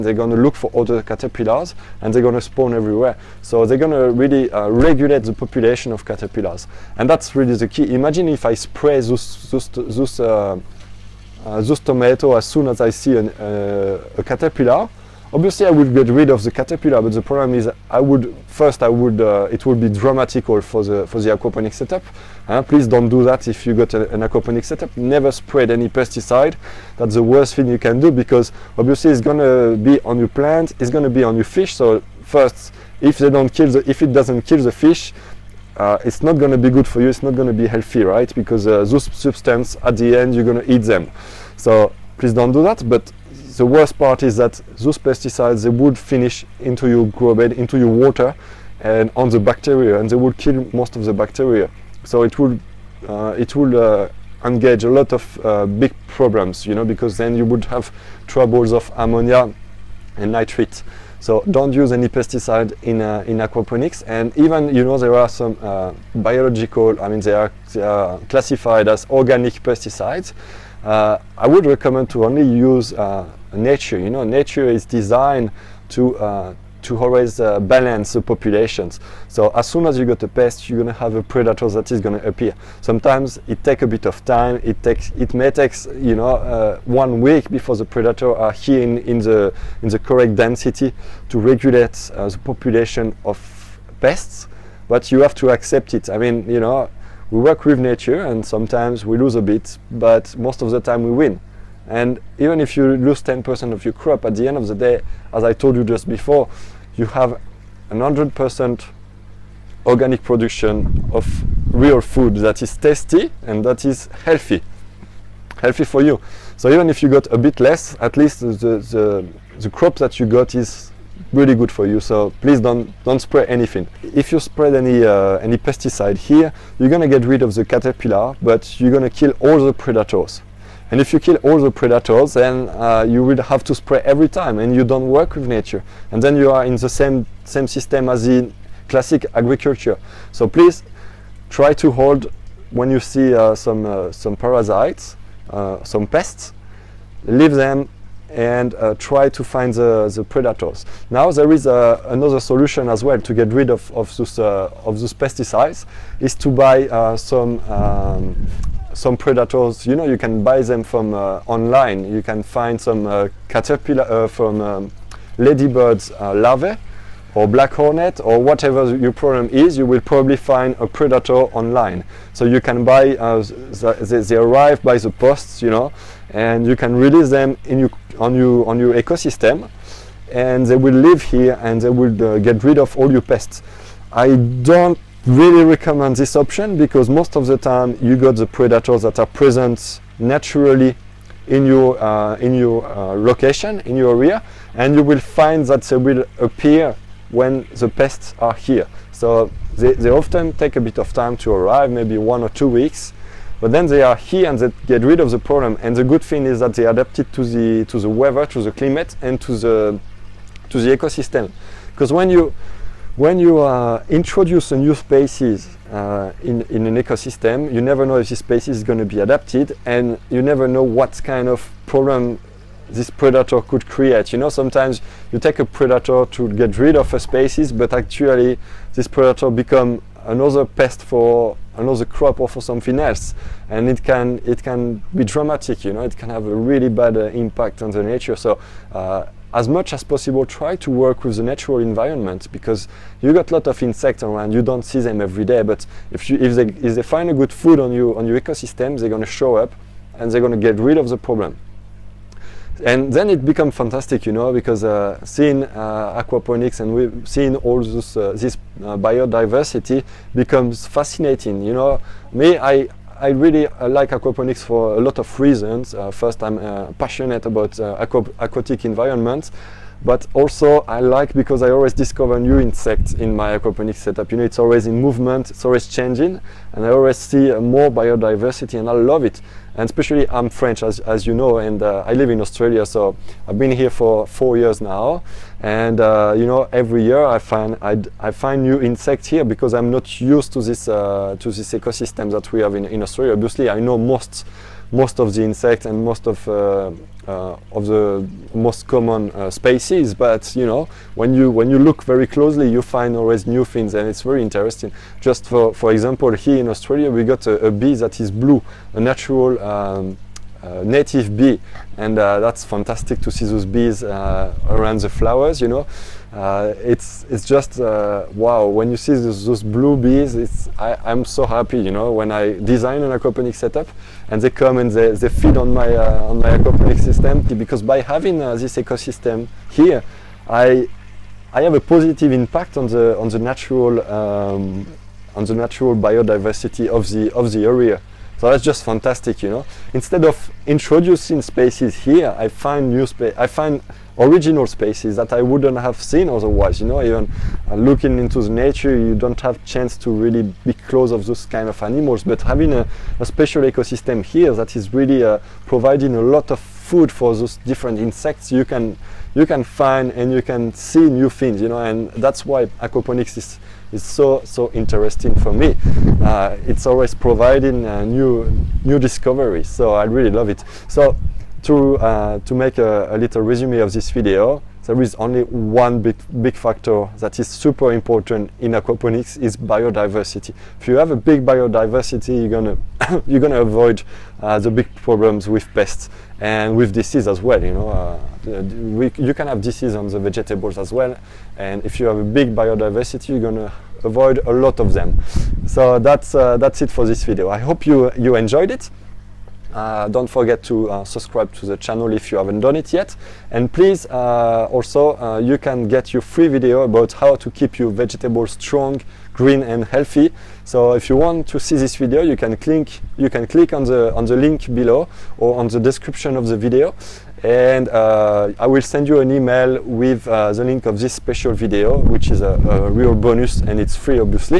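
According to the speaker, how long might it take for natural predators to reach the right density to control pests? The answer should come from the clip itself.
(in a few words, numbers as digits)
one week.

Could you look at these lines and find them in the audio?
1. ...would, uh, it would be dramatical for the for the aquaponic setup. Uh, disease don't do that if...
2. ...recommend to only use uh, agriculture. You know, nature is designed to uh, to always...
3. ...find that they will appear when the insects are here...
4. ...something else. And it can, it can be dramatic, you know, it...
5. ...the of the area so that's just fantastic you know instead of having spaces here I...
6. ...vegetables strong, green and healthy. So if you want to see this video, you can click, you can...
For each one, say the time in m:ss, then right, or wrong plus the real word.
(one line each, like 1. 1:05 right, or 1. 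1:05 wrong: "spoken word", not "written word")
1. 0:18 wrong: "please", not "disease"
2. 1:11 wrong: "nature", not "agriculture"
3. 3:15 wrong: "pests", not "insects"
4. 3:52 right
5. 5:37 wrong: "introducing", not "having"
6. 6:47 right.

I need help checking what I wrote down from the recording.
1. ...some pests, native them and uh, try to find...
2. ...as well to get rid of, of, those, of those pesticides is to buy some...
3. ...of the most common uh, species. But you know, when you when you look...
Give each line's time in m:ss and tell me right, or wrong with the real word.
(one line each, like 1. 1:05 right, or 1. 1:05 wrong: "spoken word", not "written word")
1. 2:25 wrong: "leave", not "native"
2. 2:32 right
3. 4:57 right.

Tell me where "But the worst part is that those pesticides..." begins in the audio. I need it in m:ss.
0:42.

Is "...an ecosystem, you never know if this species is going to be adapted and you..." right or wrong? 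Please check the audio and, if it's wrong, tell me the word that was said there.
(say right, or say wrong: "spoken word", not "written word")
right.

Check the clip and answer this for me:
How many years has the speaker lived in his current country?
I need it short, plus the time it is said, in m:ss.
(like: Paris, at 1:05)
4, at 4:44.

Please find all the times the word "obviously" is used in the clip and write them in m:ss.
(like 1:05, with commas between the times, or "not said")
0:15, 0:28, 4:53.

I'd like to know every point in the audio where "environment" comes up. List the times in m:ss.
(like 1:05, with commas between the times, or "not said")
4:01, 4:28.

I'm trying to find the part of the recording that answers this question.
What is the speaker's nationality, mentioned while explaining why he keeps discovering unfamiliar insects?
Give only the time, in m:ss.
4:40.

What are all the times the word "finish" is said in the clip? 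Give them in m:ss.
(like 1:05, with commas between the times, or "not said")
0:45.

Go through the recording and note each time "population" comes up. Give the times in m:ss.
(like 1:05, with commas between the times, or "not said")
0:05, 1:18, 1:32.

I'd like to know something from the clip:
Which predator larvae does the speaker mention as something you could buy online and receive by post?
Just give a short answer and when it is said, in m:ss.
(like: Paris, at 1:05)
ladybirds larvae, at 2:45.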